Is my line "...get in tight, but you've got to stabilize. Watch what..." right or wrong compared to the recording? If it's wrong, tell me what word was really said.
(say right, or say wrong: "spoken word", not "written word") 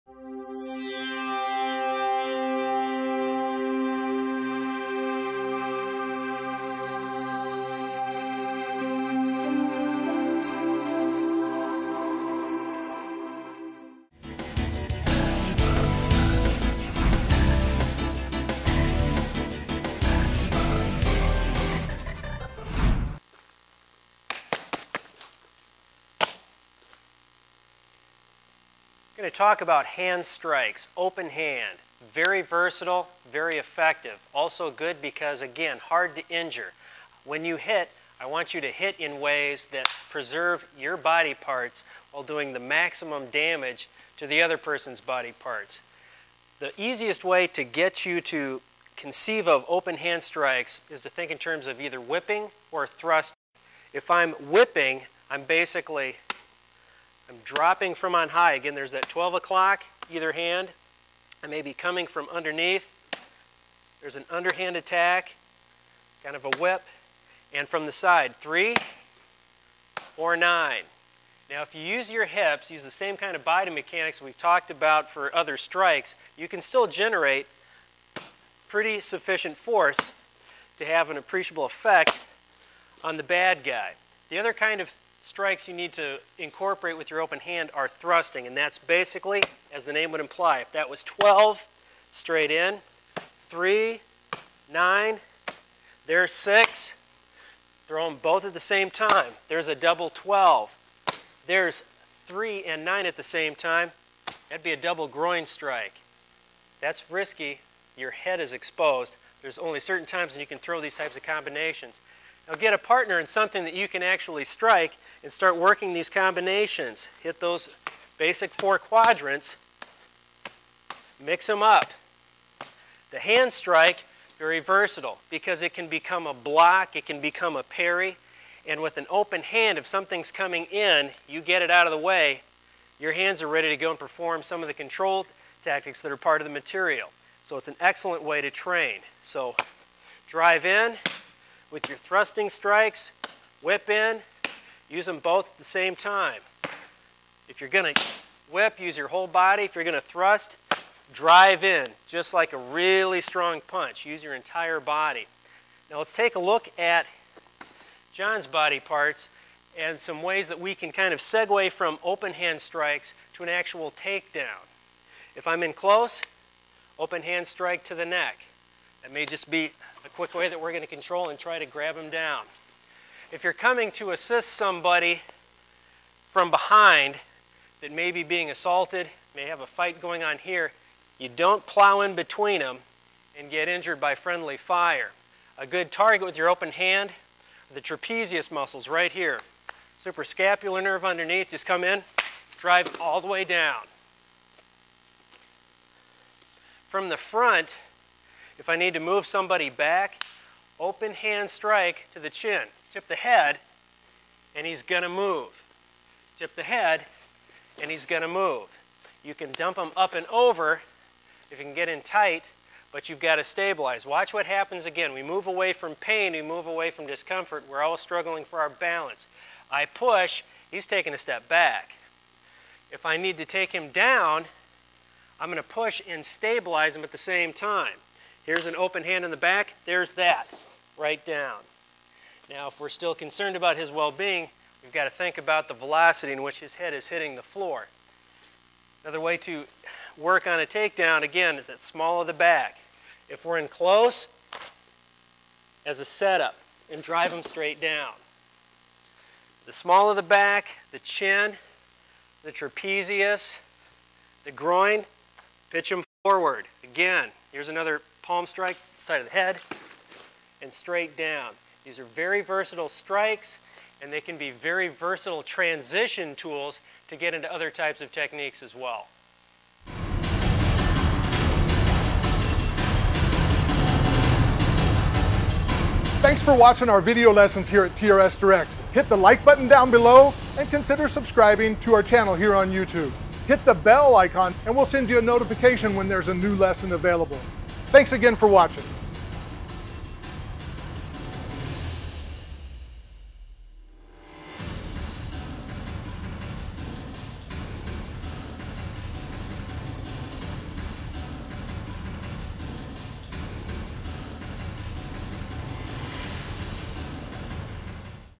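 right.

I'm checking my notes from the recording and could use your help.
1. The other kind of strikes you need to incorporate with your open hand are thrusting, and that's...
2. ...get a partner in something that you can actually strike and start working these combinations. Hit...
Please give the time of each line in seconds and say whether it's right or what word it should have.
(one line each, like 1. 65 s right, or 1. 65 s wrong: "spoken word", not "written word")
1. 84 s right
2. 112 s right.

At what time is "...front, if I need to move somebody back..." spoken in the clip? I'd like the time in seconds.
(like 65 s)
197 s.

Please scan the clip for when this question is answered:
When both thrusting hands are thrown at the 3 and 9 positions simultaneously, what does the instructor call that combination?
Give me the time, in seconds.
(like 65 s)
104 s.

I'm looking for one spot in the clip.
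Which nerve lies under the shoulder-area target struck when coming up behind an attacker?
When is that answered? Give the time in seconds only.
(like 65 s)
189 s.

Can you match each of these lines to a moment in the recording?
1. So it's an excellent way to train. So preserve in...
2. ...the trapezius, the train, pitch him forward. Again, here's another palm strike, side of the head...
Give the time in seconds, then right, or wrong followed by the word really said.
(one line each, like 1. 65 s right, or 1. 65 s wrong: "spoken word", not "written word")
1. 137 s wrong: "drive", not "preserve"
2. 252 s wrong: "groin", not "train".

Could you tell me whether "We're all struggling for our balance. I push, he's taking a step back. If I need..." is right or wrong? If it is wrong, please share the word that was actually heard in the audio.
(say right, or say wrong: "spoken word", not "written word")
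right.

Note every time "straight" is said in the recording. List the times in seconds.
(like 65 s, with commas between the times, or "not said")
92 s, 247 s, 260 s.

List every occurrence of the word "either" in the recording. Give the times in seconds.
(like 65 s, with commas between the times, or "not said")
51 s, 60 s.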